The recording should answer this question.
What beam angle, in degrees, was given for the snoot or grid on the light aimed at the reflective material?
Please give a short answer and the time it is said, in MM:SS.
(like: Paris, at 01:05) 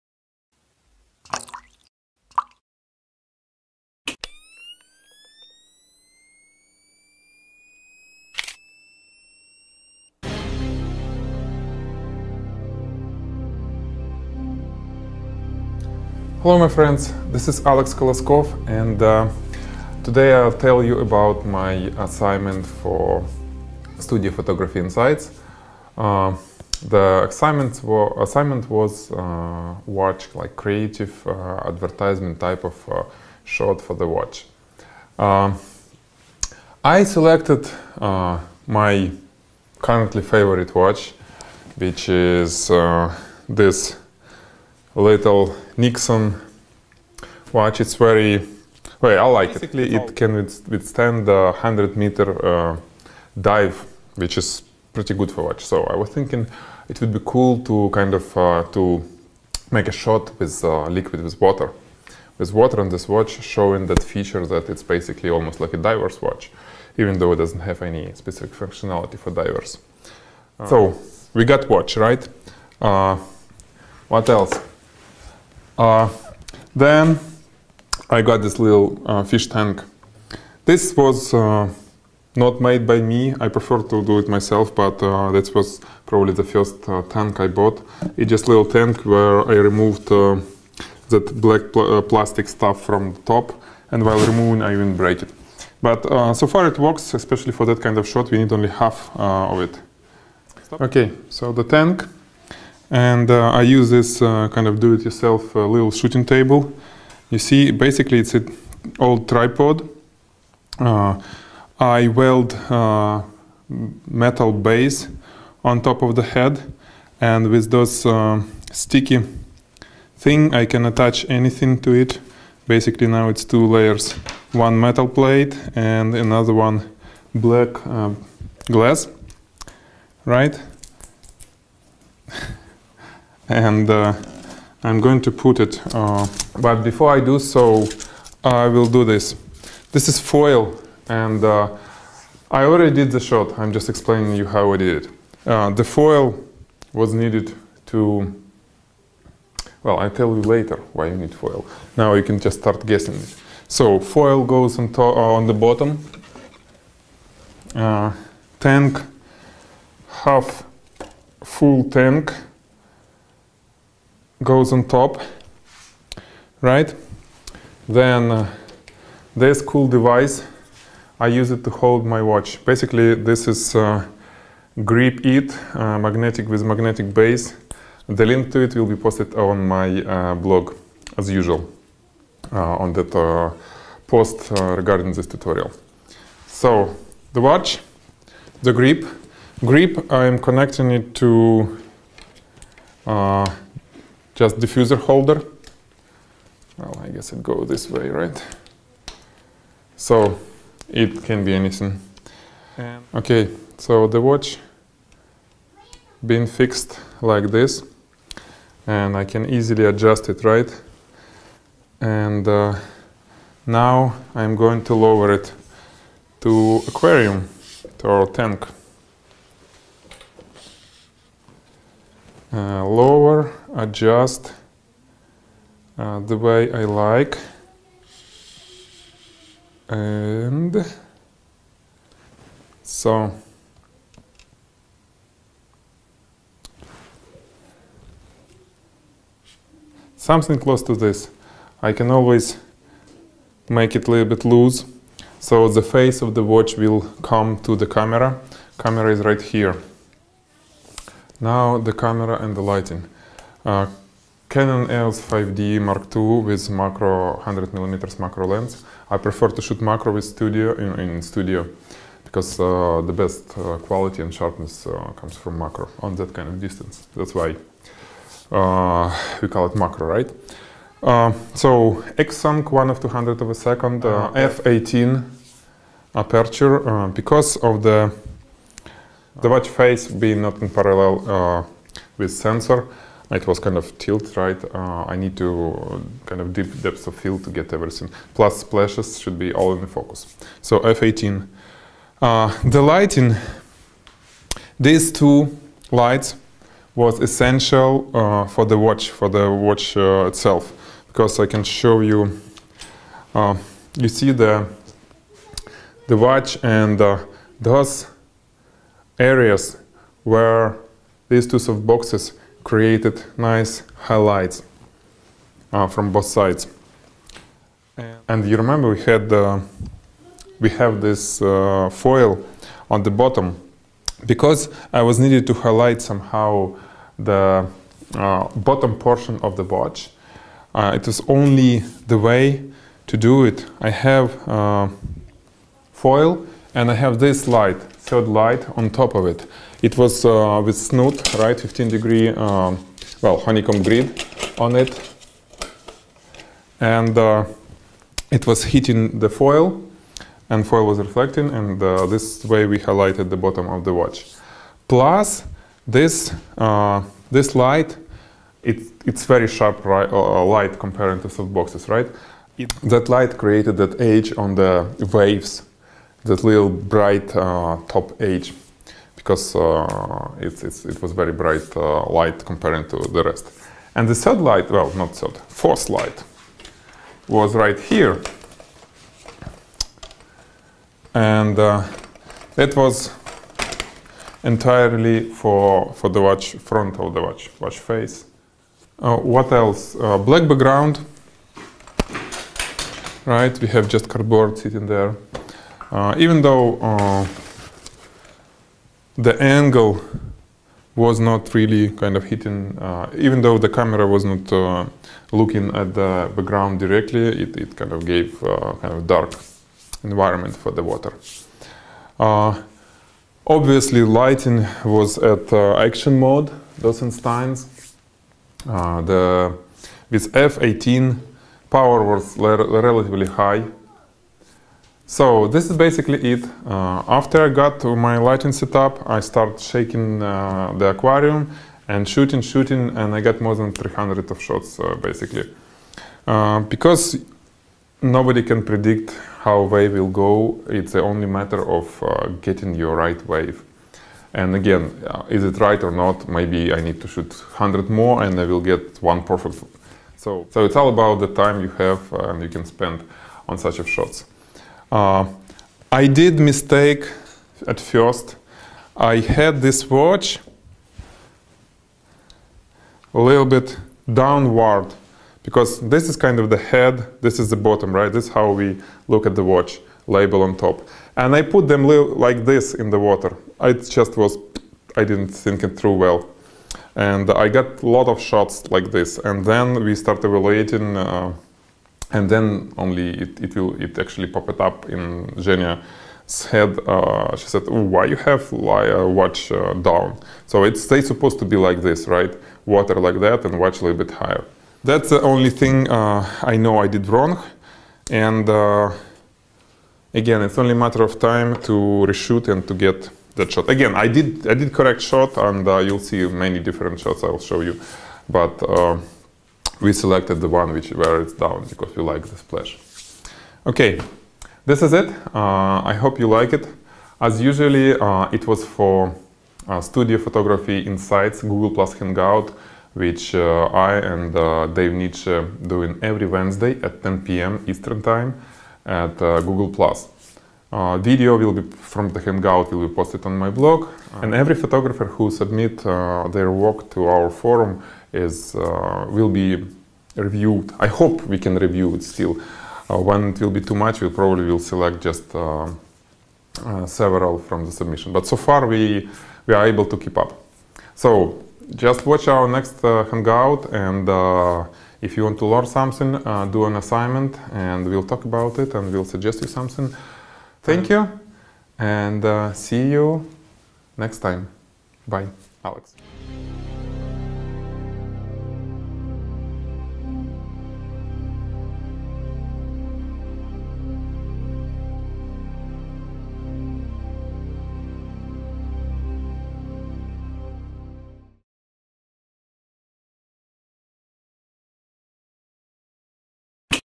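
15 degrees, at 05:41.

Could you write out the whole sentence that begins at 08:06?
Uh, she said, "Why you have uh, watch uh, down?" So it's they supposed to be like this, right?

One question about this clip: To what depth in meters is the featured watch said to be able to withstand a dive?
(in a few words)
100 meters.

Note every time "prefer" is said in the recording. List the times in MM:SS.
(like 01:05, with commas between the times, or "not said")
01:23, 04:19.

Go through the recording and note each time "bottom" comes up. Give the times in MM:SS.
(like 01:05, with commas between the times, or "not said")
02:35, 05:23, 05:28, 05:53, 07:47.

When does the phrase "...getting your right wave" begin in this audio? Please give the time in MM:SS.
07:22.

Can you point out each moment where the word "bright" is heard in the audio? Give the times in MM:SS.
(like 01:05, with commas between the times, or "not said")
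06:06, 06:11.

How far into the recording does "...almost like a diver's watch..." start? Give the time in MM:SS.
01:05.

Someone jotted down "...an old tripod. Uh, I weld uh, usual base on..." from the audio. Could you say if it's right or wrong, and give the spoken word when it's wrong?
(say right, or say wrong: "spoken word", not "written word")
wrong: "metal", not "usual".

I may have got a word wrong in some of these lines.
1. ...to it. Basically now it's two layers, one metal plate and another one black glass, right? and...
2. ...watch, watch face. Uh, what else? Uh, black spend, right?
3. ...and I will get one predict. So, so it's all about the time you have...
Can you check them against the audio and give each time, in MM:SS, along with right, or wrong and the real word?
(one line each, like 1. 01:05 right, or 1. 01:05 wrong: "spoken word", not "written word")
1. 02:01 right
2. 06:27 wrong: "background", not "spend"
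3. 07:28 wrong: "perfect", not "predict".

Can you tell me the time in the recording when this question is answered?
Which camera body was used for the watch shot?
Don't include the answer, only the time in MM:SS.
04:14.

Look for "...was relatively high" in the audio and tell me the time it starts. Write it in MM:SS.
07:02.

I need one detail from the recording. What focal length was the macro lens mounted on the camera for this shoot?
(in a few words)
100mm.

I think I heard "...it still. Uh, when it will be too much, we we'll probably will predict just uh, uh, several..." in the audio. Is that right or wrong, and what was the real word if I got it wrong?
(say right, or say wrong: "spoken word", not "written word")
wrong: "select", not "predict".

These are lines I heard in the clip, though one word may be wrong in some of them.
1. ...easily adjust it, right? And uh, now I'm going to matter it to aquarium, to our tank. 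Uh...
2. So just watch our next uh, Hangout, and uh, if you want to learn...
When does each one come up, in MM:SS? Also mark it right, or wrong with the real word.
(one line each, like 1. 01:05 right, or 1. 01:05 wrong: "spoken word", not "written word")
1. 03:29 wrong: "lower", not "matter"
2. 09:10 right.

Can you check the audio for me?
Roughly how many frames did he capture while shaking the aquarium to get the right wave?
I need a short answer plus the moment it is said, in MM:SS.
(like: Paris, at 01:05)
More than 300, at 07:13.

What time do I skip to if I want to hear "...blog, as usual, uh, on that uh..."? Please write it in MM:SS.
03:00.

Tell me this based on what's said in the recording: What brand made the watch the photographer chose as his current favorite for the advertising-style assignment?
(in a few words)
Nixon.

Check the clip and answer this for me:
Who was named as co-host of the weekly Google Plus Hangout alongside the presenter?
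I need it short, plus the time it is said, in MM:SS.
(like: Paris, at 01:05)
Dave Nitsche, at 08:44.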